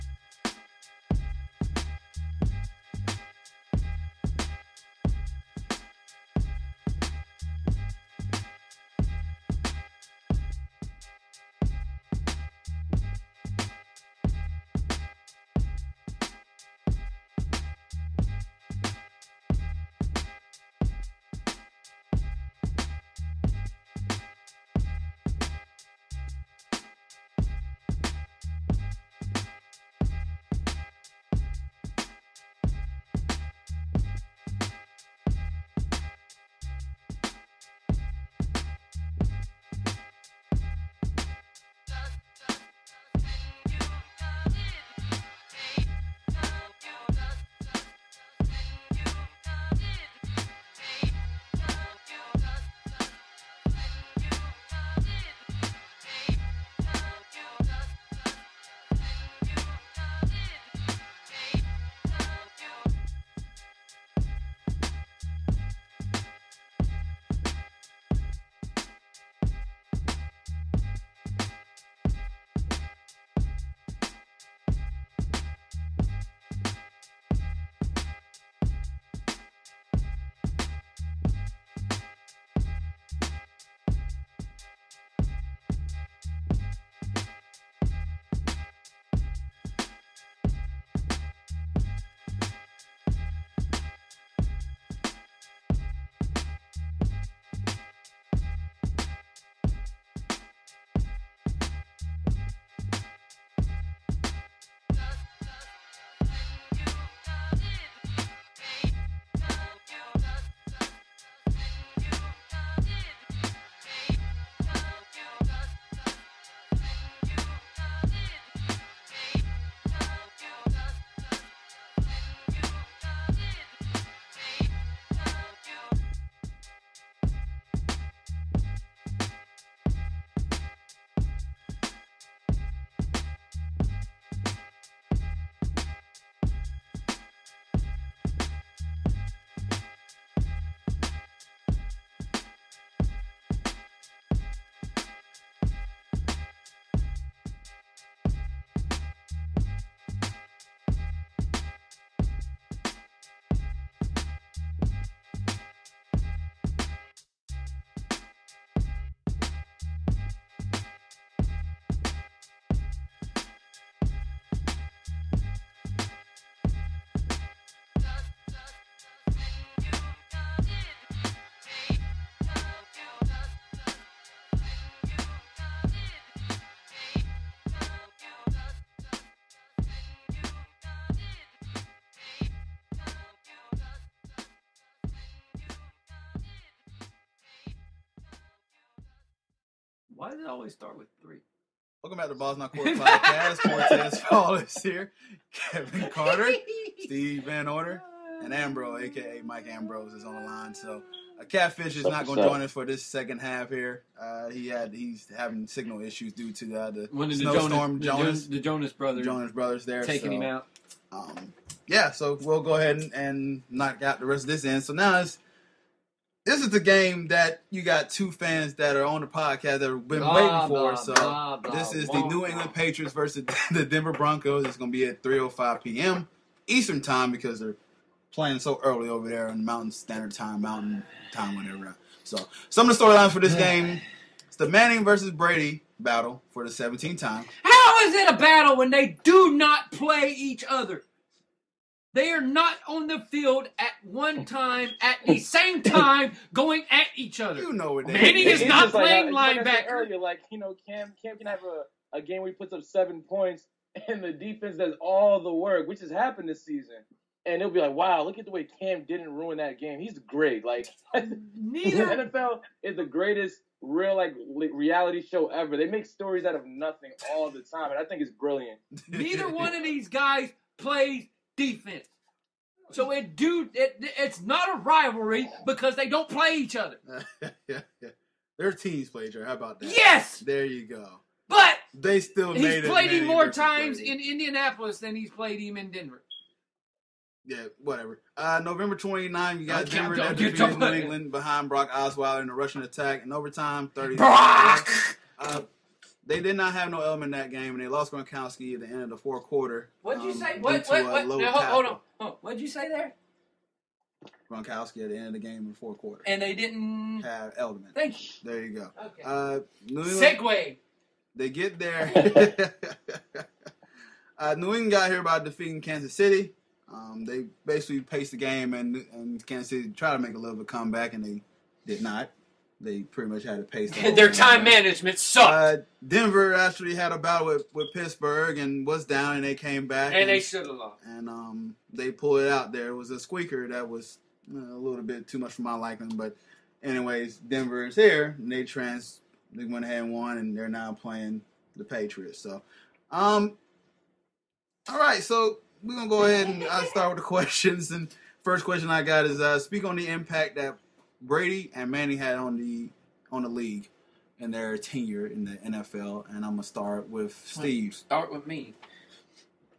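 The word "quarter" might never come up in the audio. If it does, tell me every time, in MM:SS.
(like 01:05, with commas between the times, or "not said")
04:59, 05:05.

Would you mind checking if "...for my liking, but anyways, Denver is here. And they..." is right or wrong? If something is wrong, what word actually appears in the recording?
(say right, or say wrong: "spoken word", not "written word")
right.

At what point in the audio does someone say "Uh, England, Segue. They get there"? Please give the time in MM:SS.
05:09.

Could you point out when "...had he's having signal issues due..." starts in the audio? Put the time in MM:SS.
03:24.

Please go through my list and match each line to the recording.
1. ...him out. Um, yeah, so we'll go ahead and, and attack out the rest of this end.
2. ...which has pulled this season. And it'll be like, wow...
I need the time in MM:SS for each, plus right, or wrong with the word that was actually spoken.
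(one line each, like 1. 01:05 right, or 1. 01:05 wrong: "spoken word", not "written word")
1. 03:30 wrong: "knock", not "attack"
2. 04:15 wrong: "happened", not "pulled".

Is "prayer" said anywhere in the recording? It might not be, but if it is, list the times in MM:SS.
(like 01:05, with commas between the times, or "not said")
not said.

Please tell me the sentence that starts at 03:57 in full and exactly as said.
How is it a battle when they do not play each other?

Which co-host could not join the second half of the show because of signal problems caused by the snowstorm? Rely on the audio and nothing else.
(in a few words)
Catfish.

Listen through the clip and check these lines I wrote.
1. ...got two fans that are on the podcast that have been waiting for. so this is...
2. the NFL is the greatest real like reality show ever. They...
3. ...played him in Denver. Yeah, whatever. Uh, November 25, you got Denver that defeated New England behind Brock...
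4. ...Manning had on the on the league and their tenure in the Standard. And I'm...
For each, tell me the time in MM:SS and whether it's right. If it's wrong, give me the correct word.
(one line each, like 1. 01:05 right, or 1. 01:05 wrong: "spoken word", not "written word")
1. 03:37 right
2. 04:22 right
3. 04:45 wrong: "29", not "25"
4. 05:51 wrong: "NFL", not "Standard".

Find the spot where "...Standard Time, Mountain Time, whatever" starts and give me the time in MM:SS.
03:49.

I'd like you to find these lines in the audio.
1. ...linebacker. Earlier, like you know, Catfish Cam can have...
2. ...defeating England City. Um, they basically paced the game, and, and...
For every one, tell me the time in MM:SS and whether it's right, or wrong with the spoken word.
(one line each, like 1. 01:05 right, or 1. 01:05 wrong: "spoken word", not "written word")
1. 04:09 wrong: "Cam", not "Catfish"
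2. 05:15 wrong: "Kansas", not "England".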